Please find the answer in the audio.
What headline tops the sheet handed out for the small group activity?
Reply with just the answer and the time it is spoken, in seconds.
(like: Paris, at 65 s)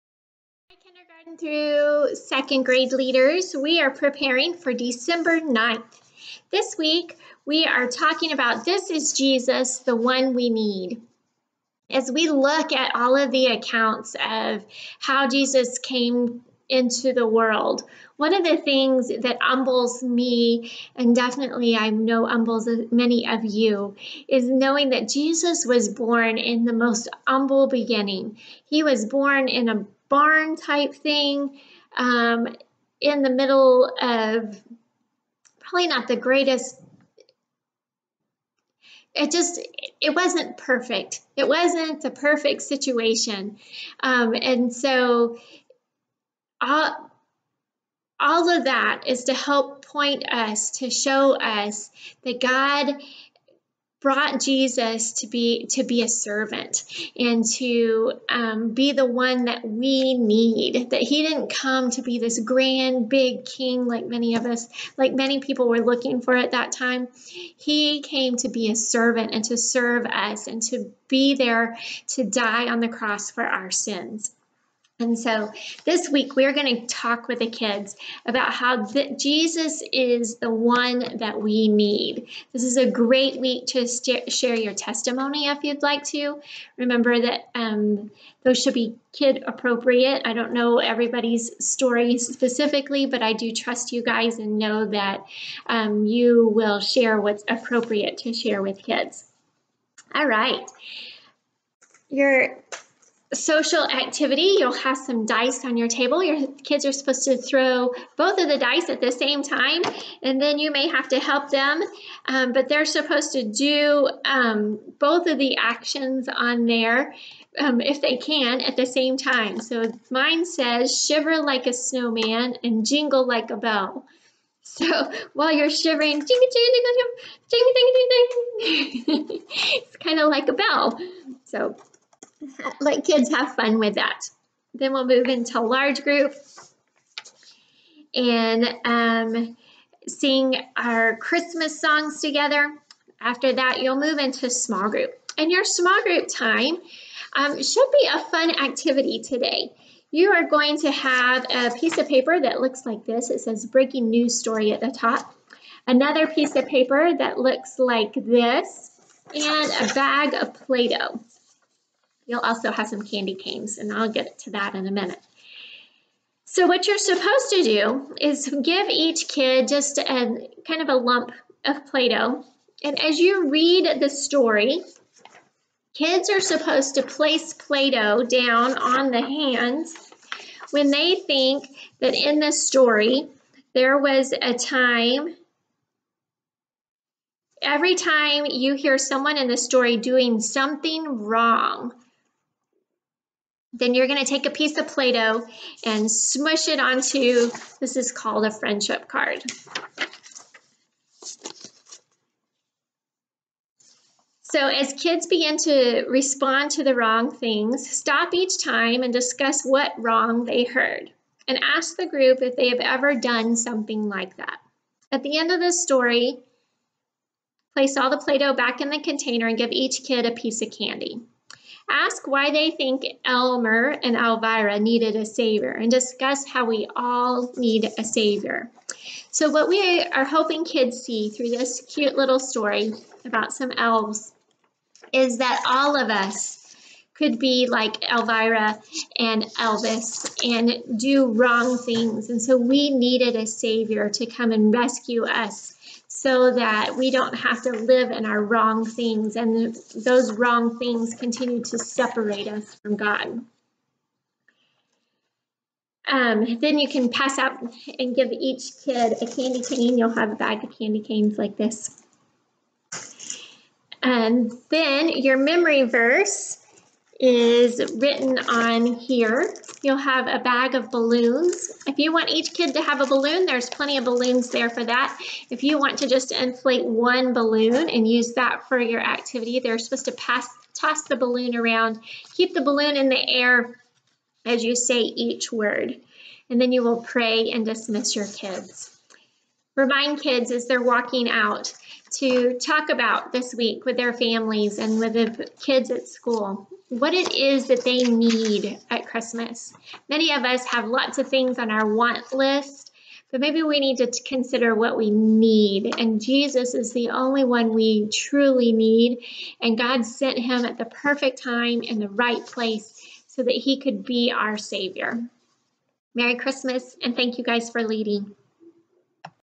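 Breaking news story, at 153 s.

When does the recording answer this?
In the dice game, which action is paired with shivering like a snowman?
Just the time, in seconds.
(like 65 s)
122 s.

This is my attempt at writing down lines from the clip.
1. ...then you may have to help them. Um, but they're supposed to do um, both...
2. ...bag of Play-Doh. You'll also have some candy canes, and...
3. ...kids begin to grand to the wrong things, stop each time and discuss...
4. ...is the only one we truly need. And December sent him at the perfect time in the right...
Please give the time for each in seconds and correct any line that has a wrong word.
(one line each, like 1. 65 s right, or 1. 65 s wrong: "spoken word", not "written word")
1. 110 s right
2. 159 s right
3. 204 s wrong: "respond", not "grand"
4. 306 s wrong: "God", not "December".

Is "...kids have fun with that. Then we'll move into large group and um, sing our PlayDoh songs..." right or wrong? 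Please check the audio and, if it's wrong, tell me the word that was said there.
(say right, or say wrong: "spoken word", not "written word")
wrong: "Christmas", not "PlayDoh".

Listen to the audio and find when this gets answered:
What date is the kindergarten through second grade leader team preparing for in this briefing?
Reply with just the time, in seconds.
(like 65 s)
4 s.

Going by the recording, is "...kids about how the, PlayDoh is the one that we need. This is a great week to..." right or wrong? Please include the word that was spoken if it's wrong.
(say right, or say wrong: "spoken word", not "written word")
wrong: "Jesus", not "PlayDoh".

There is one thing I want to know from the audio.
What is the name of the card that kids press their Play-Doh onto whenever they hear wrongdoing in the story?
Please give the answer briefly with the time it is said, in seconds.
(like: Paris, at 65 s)
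Friendship card, at 198 s.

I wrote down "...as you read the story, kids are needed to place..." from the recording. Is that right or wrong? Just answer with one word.
wrong.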